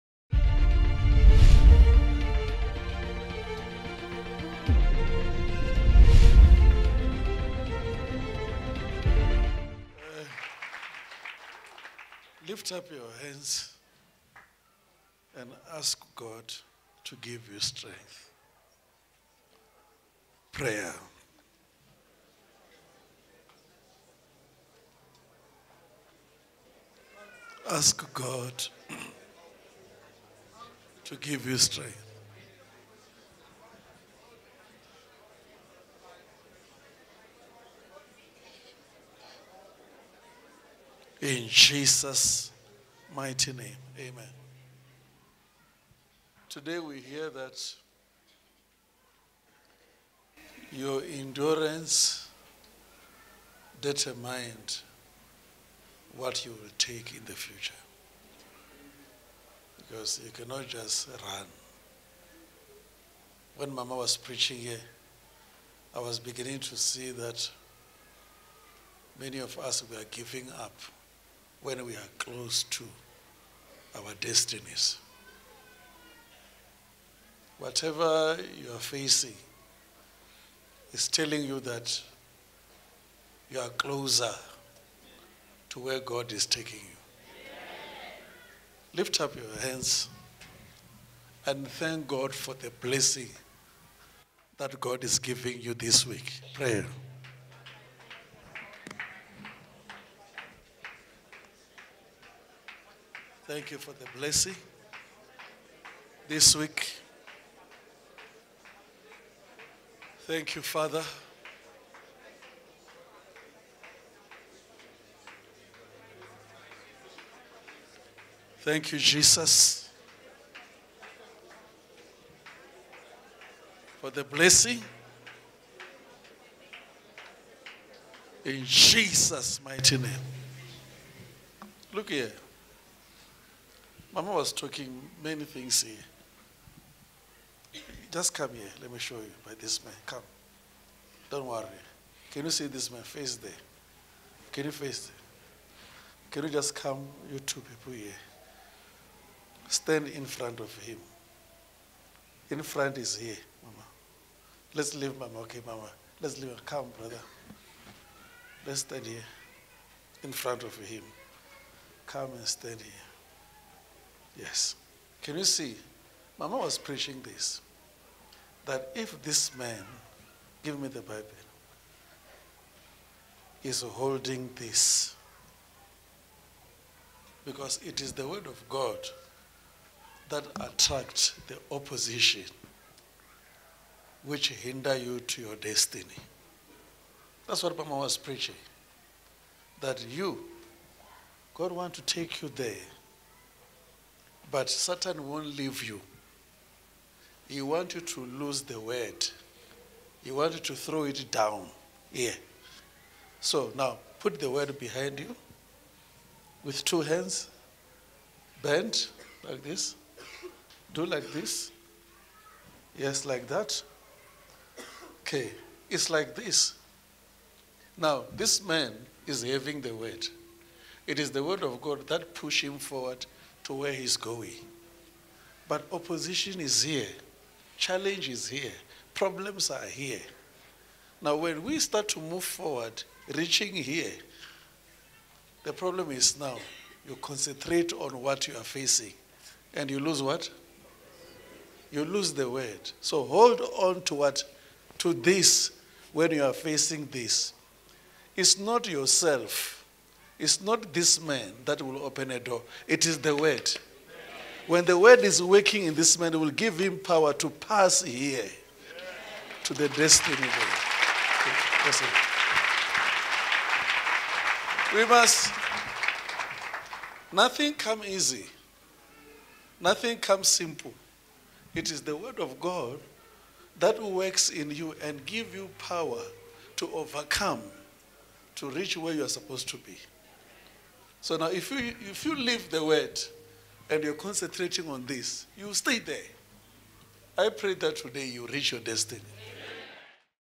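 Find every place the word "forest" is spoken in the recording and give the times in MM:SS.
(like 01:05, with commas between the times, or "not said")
not said.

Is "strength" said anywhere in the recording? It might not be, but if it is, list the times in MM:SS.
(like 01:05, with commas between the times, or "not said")
00:17, 00:31.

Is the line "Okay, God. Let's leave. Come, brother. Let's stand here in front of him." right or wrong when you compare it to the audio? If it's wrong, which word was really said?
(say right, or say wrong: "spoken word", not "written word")
wrong: "Mama", not "God".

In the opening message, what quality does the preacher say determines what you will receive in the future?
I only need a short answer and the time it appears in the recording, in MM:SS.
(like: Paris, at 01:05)
endurance, at 00:51.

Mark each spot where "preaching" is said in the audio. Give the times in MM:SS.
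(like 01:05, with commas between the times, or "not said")
01:04, 02:46, 03:08.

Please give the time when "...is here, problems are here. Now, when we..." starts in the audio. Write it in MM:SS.
03:48.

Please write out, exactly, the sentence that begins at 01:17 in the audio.
Whatever you are facing is telling you that you are closer to where God is taking you.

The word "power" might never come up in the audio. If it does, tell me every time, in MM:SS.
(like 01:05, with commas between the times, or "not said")
04:16, 04:35.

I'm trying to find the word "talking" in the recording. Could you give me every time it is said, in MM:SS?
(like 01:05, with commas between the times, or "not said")
02:14.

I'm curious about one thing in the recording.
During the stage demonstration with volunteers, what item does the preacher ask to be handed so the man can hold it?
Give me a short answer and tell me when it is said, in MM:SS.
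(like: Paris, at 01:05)
the Bible, at 02:50.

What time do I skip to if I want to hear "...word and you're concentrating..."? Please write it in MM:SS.
04:42.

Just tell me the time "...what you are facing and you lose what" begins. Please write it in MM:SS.
03:58.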